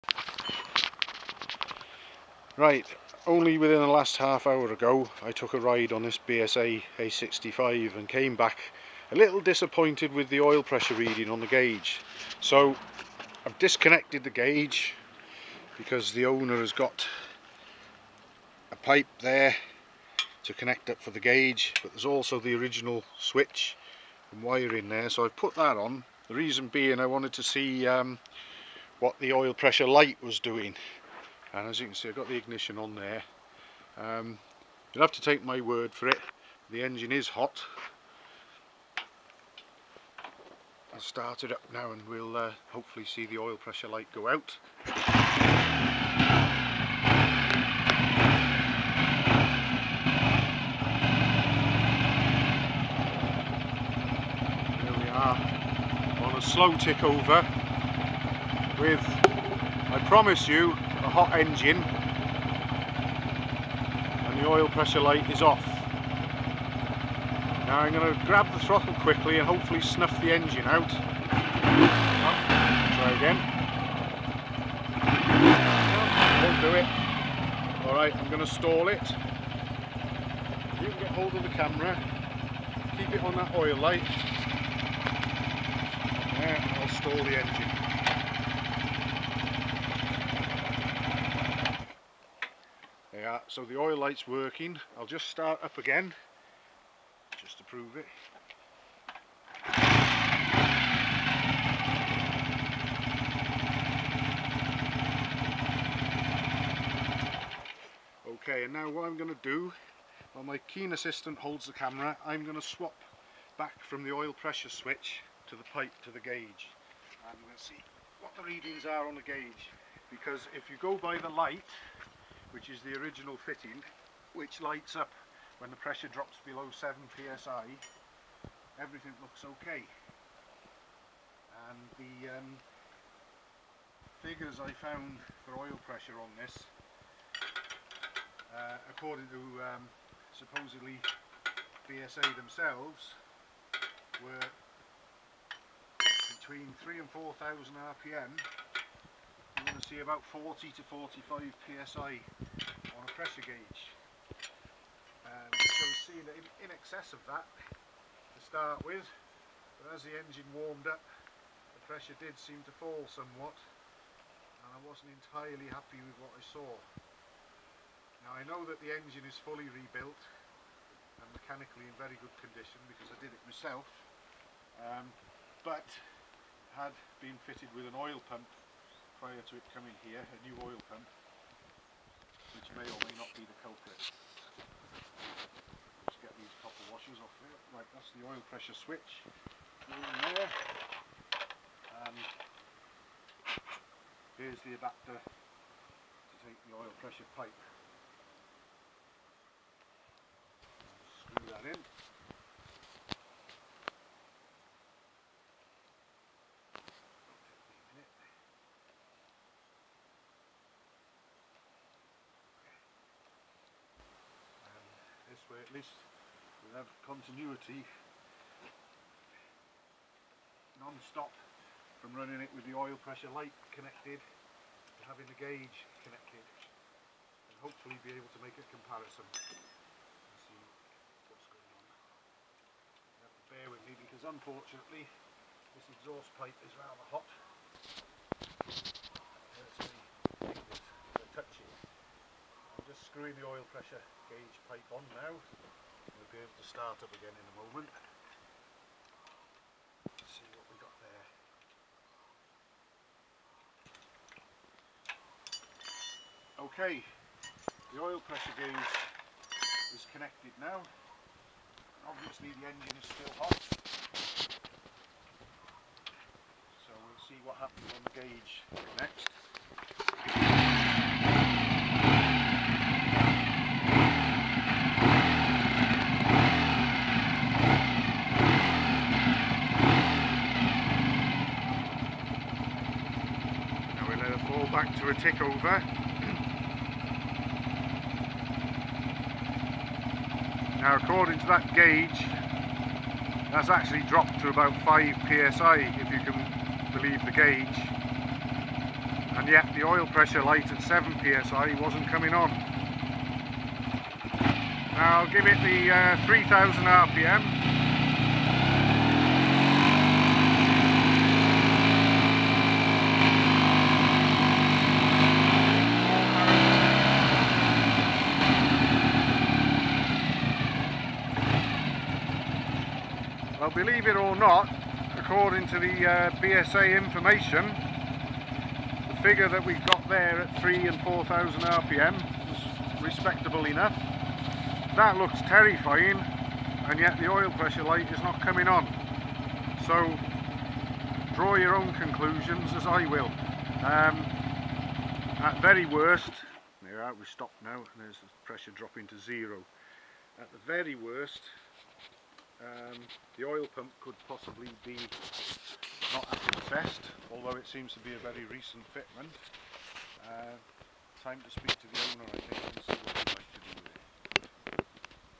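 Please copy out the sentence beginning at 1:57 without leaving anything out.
And we'll see what the readings are on the gauge.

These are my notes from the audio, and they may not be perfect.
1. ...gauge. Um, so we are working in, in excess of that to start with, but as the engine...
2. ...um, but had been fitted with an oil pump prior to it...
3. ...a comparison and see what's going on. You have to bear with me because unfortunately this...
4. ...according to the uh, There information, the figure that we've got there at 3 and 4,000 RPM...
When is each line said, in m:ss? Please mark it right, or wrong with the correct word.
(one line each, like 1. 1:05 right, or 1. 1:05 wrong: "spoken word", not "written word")
1. 2:33 wrong: "seeing", not "working"
2. 2:54 right
3. 3:48 right
4. 5:25 wrong: "BSA", not "There".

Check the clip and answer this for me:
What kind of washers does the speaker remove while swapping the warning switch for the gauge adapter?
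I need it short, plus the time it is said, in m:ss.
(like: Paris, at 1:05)
copper washers, at 3:06.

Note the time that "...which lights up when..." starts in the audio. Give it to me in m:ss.
2:04.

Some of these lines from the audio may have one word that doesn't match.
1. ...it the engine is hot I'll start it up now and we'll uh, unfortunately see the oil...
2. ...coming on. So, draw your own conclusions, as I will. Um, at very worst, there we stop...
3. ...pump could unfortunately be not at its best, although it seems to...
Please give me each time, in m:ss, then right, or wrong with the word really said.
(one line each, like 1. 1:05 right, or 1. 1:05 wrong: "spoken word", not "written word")
1. 0:36 wrong: "hopefully", not "unfortunately"
2. 5:38 right
3. 5:53 wrong: "possibly", not "unfortunately".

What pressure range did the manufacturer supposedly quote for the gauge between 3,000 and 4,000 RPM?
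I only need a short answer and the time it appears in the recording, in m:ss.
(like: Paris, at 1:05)
40 to 45 psi, at 2:30.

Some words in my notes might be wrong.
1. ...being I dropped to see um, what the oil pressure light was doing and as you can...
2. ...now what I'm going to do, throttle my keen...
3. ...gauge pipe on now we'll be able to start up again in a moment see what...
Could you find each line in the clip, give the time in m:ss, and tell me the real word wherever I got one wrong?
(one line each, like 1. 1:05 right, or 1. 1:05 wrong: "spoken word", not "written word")
1. 0:26 wrong: "wanted", not "dropped"
2. 1:48 wrong: "while", not "throttle"
3. 4:04 right.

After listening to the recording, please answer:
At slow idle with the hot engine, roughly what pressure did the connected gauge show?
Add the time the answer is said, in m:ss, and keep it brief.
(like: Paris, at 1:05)
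about 5 psi, at 4:54.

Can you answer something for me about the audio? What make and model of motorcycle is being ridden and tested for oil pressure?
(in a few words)
BSA A65.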